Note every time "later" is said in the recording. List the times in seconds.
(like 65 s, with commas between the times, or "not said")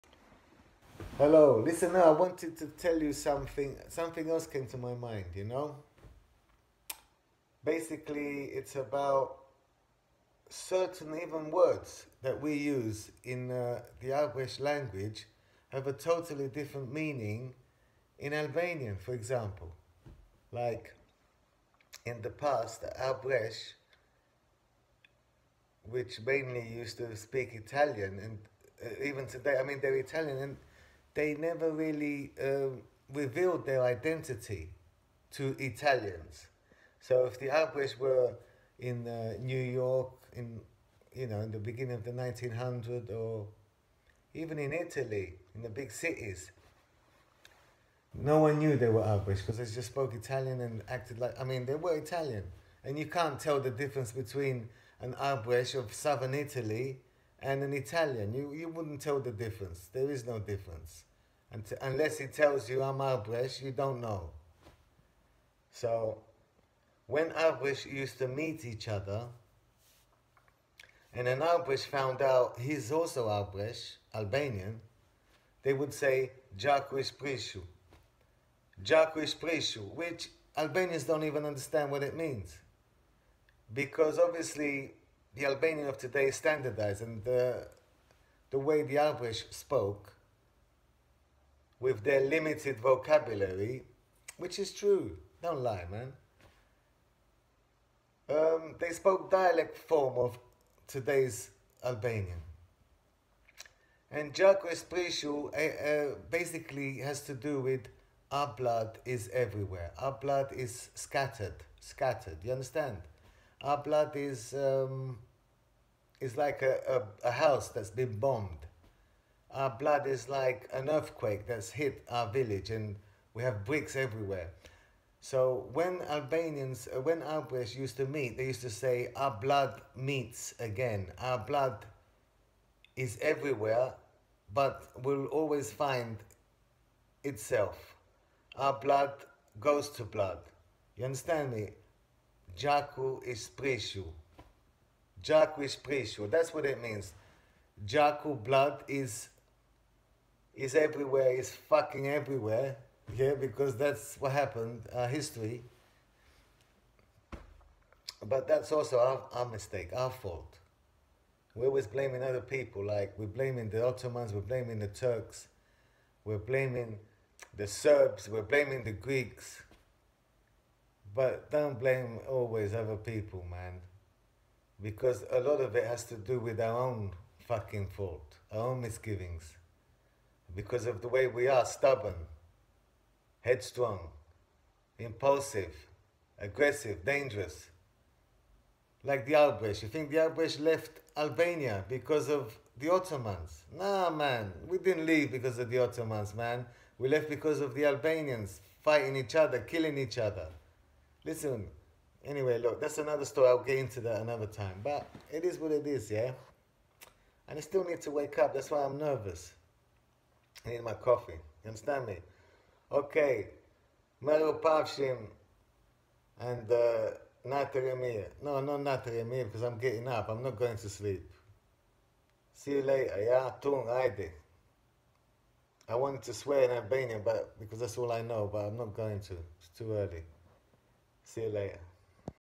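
222 s, 231 s.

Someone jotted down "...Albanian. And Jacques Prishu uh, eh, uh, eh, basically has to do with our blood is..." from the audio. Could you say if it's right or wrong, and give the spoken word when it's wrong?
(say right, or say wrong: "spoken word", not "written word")
right.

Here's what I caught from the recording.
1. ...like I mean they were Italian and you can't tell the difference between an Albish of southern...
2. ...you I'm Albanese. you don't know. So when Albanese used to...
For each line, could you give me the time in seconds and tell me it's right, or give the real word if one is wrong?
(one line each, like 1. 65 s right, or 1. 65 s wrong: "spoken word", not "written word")
1. 51 s right
2. 62 s right.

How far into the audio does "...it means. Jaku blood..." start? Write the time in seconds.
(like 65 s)
146 s.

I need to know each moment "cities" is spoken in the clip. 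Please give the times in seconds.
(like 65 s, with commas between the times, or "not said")
45 s.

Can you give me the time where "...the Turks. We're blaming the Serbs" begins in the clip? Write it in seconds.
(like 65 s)
164 s.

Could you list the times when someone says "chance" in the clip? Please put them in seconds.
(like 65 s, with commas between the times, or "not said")
not said.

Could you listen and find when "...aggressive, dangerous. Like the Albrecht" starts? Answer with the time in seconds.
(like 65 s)
186 s.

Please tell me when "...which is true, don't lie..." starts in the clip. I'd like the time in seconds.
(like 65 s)
94 s.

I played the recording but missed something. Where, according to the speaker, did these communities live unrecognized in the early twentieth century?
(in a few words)
New York.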